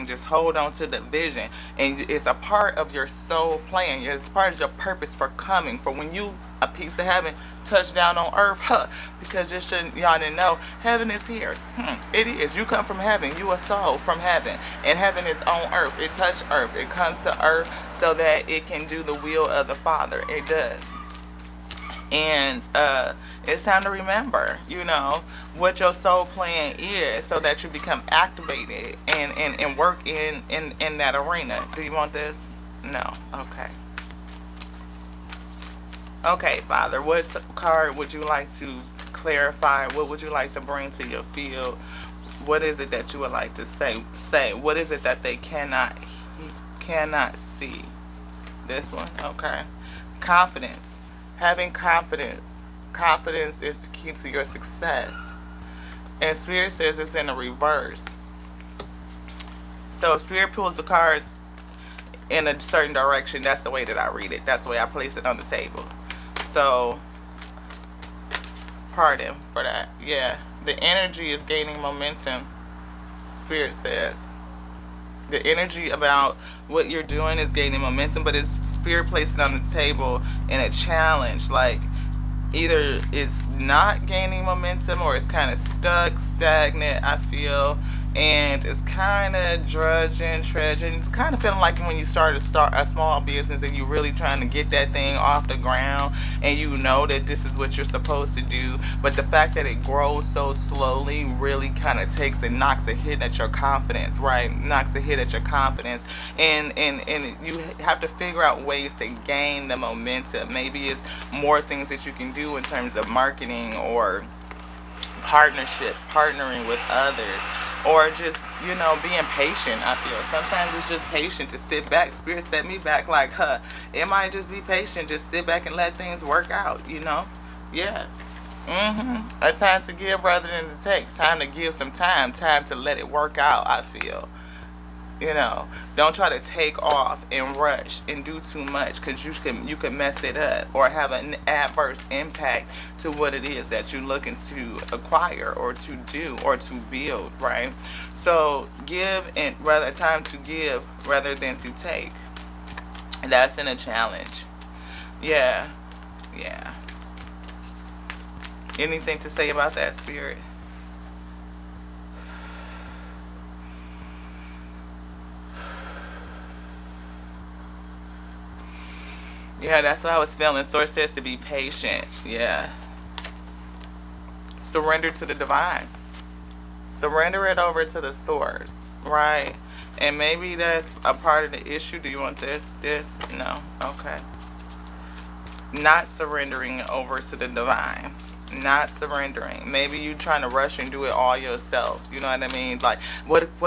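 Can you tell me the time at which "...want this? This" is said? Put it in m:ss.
3:02.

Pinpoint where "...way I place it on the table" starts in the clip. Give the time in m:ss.
1:04.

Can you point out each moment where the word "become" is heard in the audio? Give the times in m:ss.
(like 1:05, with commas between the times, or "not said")
0:27.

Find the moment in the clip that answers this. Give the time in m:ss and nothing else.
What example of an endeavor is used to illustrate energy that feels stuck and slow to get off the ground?
1:32.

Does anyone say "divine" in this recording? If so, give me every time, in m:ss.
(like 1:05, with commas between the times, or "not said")
2:55, 3:07.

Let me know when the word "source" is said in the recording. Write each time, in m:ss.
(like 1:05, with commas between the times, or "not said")
2:50, 2:58.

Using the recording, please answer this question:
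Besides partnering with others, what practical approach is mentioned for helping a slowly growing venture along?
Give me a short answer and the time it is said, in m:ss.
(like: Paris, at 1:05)
Marketing, at 1:53.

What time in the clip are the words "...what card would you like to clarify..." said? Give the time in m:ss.
0:37.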